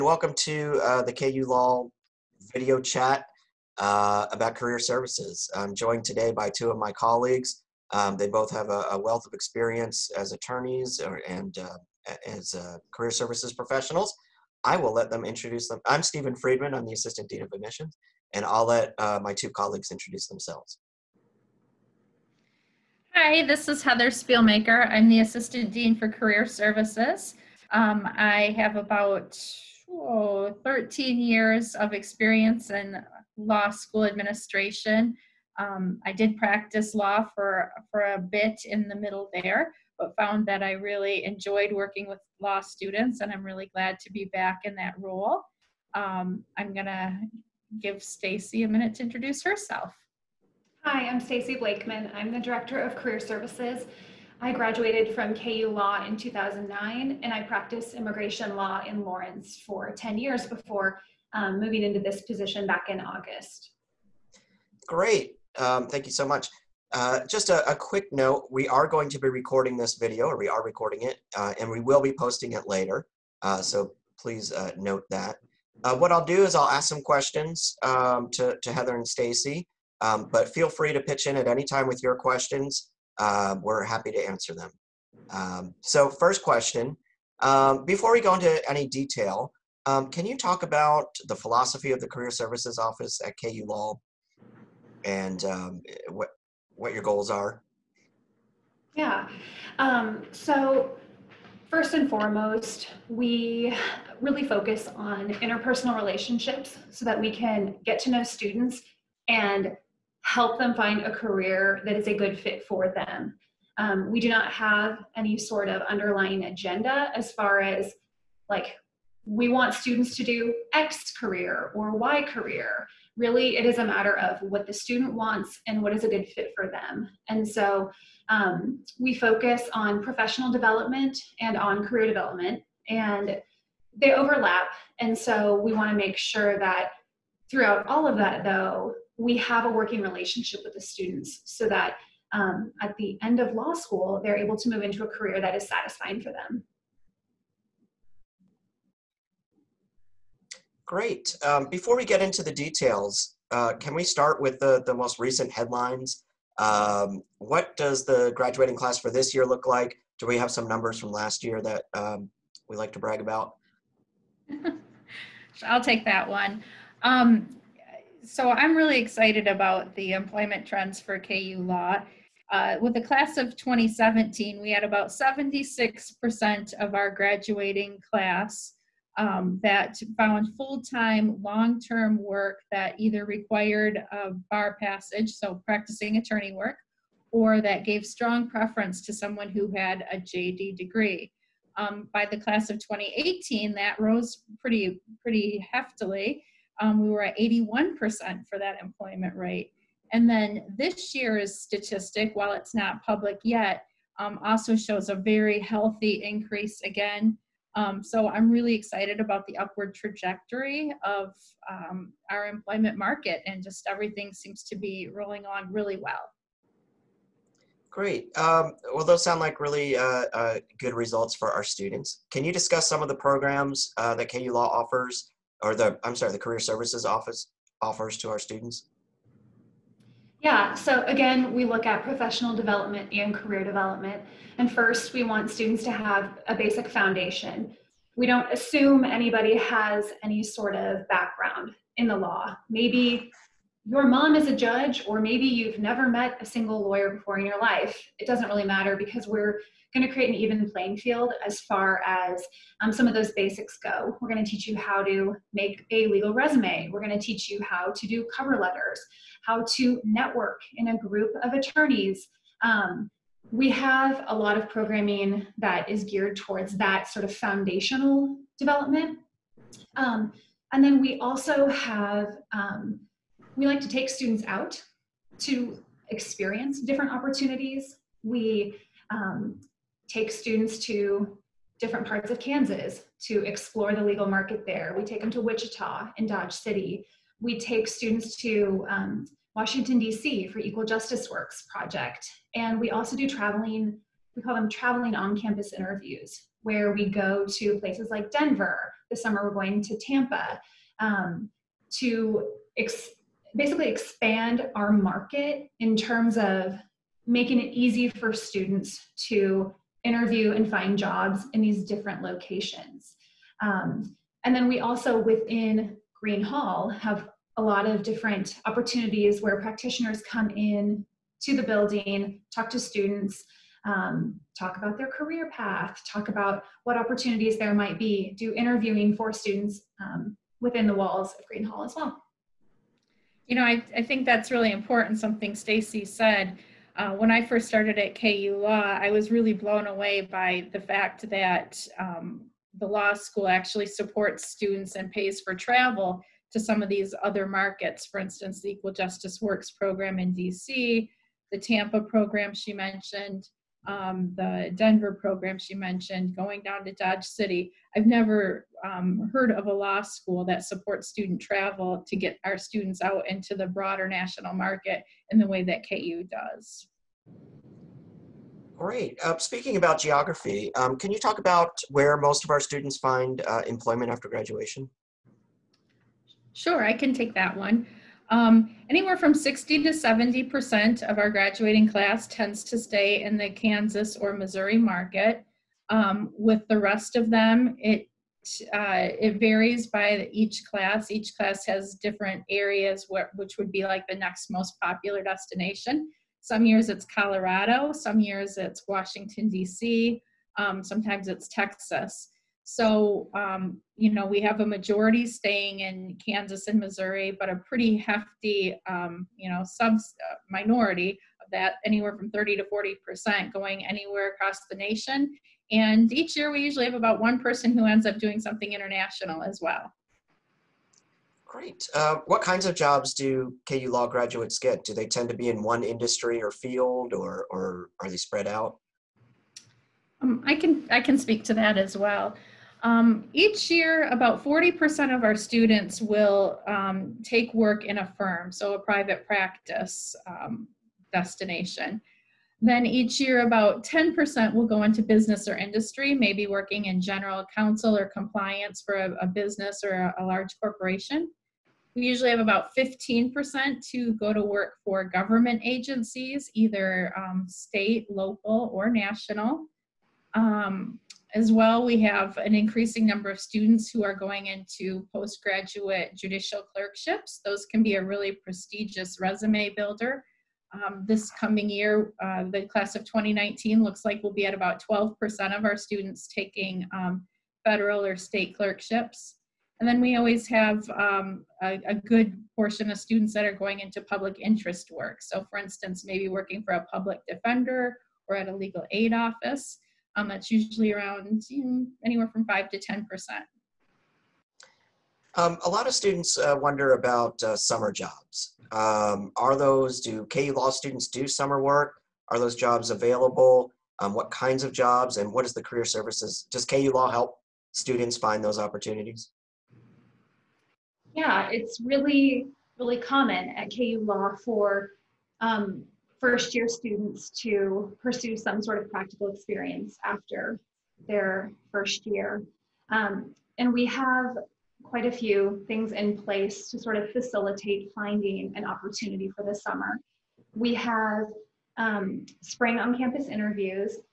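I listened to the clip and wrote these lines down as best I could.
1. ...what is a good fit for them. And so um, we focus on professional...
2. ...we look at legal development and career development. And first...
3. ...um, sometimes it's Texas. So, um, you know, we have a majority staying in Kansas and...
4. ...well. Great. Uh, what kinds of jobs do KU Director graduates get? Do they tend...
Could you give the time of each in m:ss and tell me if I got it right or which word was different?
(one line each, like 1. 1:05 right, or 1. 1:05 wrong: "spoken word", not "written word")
1. 2:05 right
2. 3:51 wrong: "professional", not "legal"
3. 6:40 right
4. 6:59 wrong: "Law", not "Director".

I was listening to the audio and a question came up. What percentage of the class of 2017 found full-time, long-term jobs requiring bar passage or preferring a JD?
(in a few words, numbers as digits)
76%.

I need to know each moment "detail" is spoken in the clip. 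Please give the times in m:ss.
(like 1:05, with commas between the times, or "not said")
1:28, 2:32.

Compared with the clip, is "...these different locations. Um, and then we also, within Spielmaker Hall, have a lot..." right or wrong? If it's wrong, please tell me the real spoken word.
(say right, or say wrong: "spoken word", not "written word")
wrong: "Green", not "Spielmaker".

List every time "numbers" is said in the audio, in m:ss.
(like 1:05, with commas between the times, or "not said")
2:40, 7:43.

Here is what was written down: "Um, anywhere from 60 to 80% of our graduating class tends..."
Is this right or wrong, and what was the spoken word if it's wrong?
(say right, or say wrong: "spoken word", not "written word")
wrong: "70", not "80".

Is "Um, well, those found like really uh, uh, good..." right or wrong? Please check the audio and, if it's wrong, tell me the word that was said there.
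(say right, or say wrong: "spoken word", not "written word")
wrong: "sound", not "found".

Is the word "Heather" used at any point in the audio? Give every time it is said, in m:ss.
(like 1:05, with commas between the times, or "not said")
0:23, 1:18.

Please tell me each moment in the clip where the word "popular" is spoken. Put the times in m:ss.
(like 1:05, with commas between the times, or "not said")
6:34.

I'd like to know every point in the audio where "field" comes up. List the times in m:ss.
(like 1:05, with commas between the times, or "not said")
4:10, 7:06.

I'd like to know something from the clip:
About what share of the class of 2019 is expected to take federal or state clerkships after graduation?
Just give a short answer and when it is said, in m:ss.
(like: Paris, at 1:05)
12%, at 7:54.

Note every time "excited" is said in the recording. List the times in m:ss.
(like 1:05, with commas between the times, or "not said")
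2:48, 3:28.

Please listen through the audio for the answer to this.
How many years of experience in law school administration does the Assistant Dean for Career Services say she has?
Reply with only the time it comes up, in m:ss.
0:30.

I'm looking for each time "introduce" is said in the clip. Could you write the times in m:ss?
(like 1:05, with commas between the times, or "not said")
0:15, 0:19, 0:49.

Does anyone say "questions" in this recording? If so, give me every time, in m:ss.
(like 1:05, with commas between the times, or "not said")
1:17, 1:22, 1:26.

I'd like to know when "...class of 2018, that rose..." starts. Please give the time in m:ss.
3:12.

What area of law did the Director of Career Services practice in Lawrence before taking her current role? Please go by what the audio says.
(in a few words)
immigration law.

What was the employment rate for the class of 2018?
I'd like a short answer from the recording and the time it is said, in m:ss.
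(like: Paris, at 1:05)
81%, at 3:17.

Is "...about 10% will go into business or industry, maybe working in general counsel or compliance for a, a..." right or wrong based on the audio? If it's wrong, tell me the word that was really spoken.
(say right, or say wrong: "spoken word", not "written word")
right.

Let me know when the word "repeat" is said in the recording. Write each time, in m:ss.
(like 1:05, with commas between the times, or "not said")
not said.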